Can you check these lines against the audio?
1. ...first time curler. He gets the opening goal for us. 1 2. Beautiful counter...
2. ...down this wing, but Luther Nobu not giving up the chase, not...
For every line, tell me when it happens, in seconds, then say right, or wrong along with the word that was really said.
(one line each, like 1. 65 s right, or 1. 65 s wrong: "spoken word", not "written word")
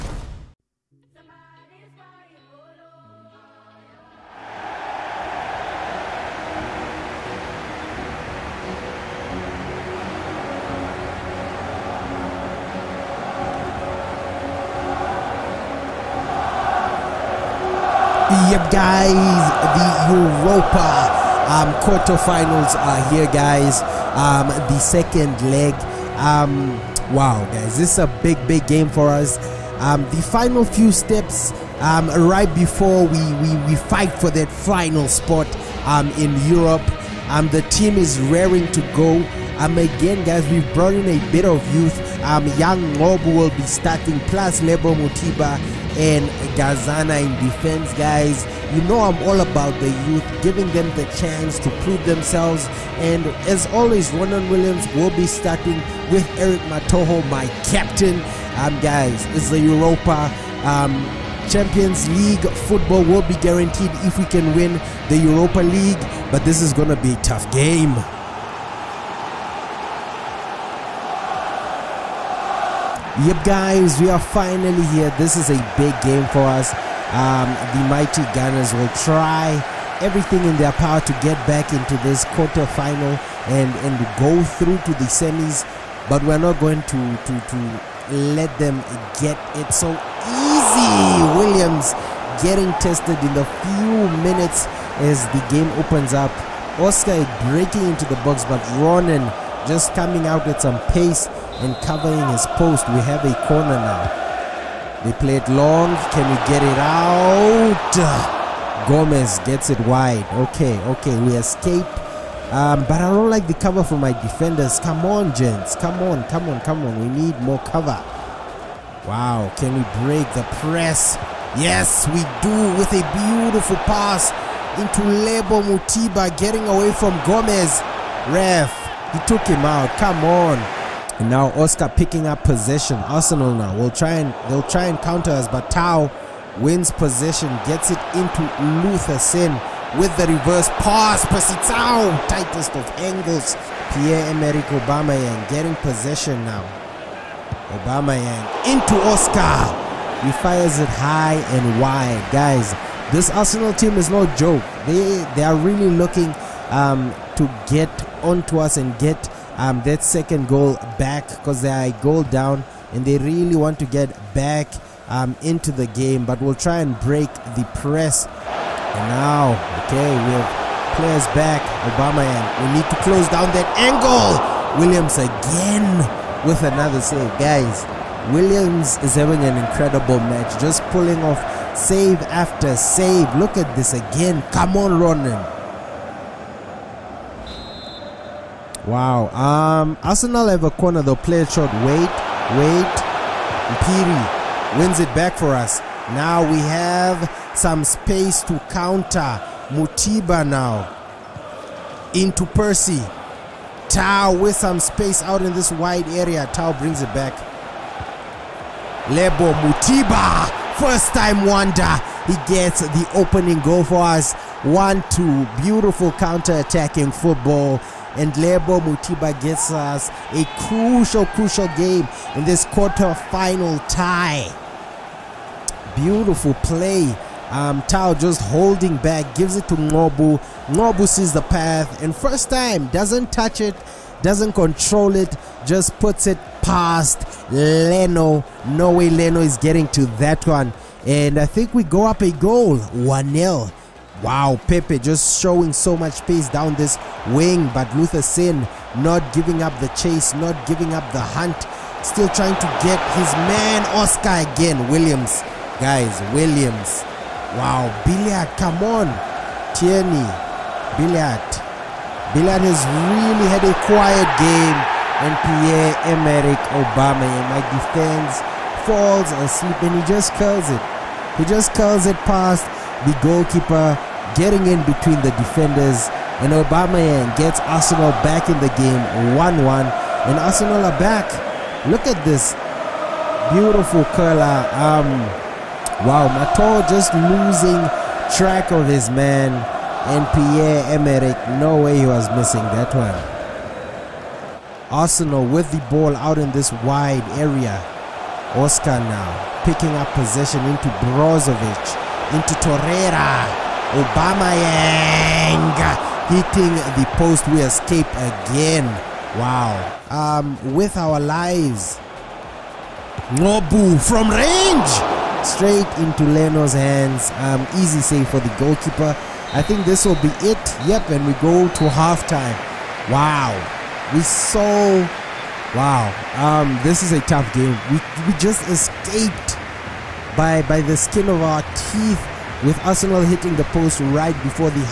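1. 210 s wrong: "wonder", not "curler"
2. 246 s wrong: "Singh", not "Nobu".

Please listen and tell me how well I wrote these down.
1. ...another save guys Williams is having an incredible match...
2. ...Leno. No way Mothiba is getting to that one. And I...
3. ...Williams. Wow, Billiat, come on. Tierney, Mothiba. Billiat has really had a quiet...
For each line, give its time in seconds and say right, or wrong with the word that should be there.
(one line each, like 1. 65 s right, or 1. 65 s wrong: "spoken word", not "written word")
1. 176 s right
2. 237 s wrong: "Leno", not "Mothiba"
3. 256 s wrong: "Billiat", not "Mothiba".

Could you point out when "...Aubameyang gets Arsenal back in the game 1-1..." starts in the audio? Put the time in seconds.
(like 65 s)
276 s.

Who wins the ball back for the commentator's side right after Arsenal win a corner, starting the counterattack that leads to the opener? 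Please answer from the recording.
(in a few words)
Piri.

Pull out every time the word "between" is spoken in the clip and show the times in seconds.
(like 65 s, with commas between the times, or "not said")
274 s.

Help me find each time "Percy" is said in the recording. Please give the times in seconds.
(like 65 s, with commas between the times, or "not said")
141 s, 202 s.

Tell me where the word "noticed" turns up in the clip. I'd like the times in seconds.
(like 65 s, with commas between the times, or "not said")
not said.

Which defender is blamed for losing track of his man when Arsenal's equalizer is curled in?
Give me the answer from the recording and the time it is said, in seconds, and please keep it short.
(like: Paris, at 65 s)
Matol, at 286 s.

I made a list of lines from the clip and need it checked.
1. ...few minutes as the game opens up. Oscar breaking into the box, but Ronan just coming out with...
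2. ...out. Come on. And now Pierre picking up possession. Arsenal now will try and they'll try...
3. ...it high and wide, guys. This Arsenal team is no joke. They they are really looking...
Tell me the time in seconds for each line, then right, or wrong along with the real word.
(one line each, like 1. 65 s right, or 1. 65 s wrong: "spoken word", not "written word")
1. 93 s right
2. 129 s wrong: "Oscar", not "Pierre"
3. 150 s right.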